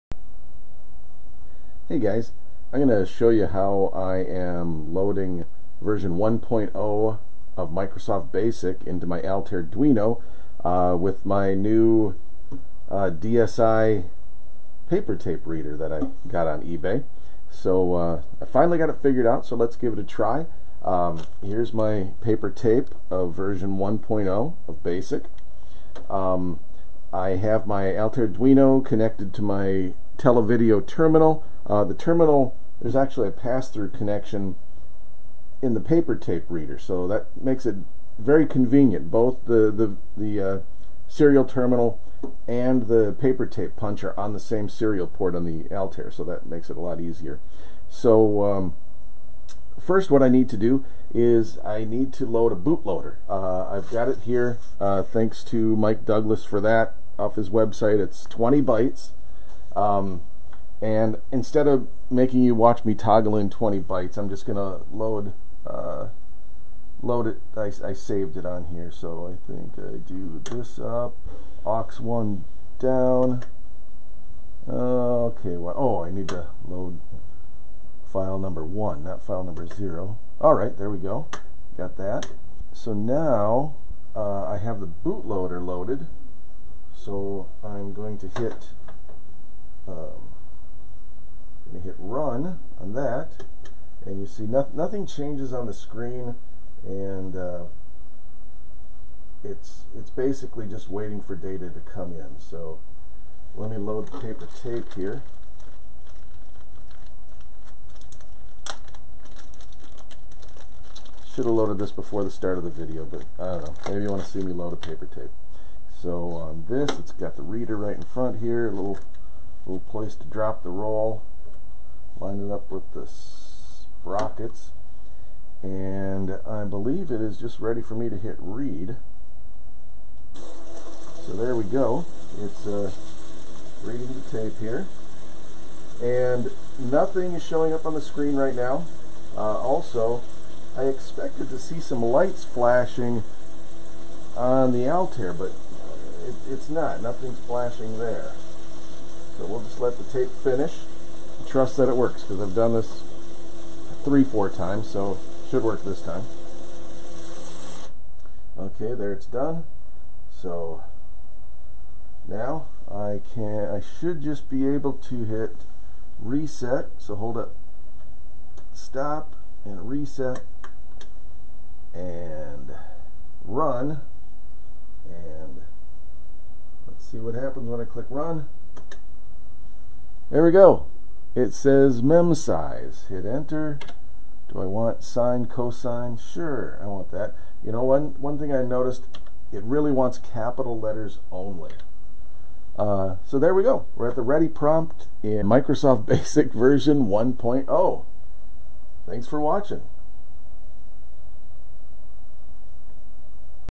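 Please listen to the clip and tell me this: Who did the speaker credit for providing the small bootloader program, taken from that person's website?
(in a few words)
Mike Douglas.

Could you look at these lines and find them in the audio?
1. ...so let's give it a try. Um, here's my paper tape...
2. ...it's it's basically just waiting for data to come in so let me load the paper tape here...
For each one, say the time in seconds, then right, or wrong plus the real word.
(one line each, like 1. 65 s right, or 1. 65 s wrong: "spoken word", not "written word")
1. 19 s right
2. 99 s right.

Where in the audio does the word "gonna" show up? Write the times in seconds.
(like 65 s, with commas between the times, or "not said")
64 s.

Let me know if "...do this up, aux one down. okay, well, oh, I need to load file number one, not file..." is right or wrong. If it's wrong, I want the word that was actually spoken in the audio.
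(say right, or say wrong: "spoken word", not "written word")
right.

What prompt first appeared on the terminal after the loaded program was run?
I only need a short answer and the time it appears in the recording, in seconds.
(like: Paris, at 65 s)
mem size, at 182 s.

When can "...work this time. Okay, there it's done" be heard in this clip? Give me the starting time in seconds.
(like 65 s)
155 s.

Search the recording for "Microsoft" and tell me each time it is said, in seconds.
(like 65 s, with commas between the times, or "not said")
7 s, 195 s.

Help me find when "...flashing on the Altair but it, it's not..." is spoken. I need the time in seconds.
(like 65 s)
142 s.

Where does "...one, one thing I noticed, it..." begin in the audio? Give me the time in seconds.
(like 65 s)
187 s.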